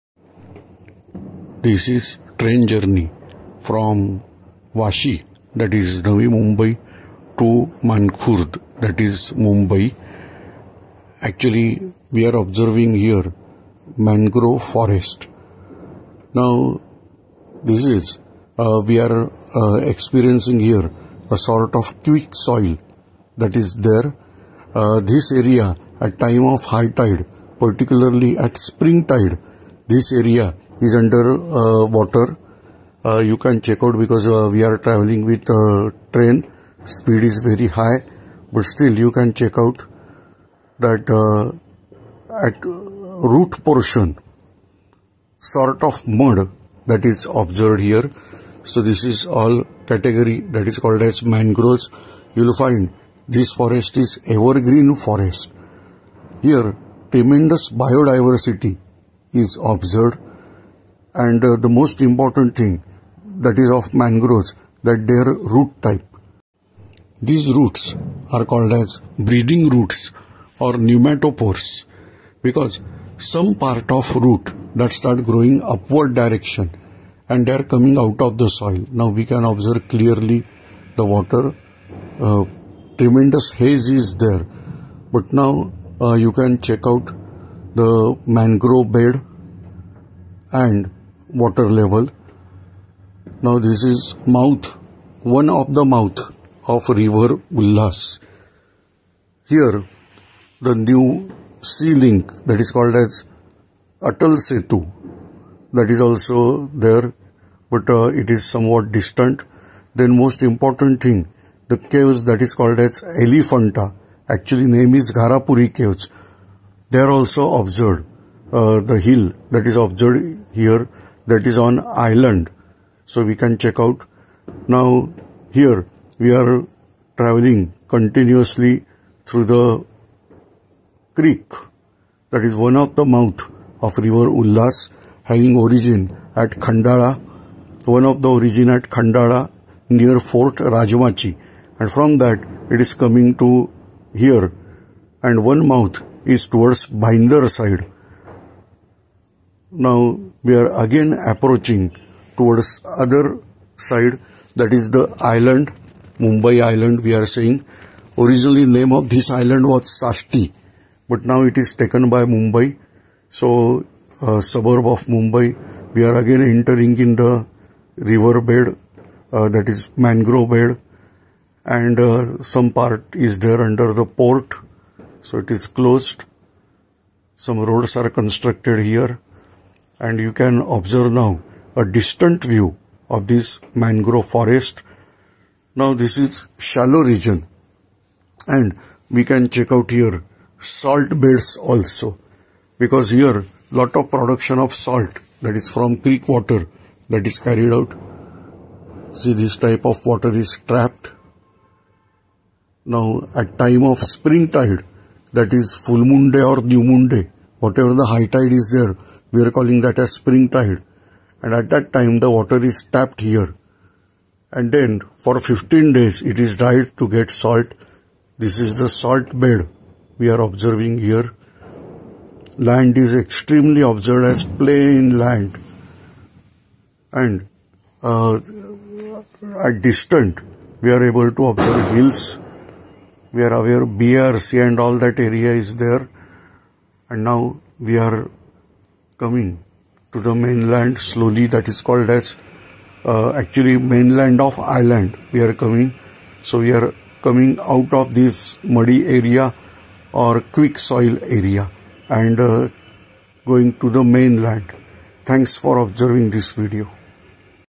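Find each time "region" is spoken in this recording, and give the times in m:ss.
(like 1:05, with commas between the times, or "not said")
3:07.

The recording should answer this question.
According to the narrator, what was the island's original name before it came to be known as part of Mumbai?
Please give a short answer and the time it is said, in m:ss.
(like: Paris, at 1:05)
Sashti, at 2:40.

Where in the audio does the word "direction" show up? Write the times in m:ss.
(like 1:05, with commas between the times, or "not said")
1:16.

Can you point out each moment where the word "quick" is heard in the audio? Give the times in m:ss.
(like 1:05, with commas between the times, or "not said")
0:22, 4:10.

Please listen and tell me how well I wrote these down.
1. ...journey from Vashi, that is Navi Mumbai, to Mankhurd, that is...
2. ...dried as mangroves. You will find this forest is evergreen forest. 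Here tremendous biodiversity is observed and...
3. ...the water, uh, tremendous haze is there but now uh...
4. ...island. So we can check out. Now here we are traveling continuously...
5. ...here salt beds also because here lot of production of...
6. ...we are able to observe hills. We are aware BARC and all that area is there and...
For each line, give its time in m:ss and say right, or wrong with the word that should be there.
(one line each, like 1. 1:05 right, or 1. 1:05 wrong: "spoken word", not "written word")
1. 0:02 right
2. 0:50 wrong: "called", not "dried"
3. 1:20 right
4. 2:01 right
5. 3:09 right
6. 3:50 right.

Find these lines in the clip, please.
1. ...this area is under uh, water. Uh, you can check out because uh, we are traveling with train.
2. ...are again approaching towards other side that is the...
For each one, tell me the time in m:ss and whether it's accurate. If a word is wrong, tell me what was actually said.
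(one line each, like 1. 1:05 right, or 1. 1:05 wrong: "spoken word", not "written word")
1. 0:29 right
2. 2:30 right.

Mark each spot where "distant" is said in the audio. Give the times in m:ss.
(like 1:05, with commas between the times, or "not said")
1:48, 3:01, 3:49.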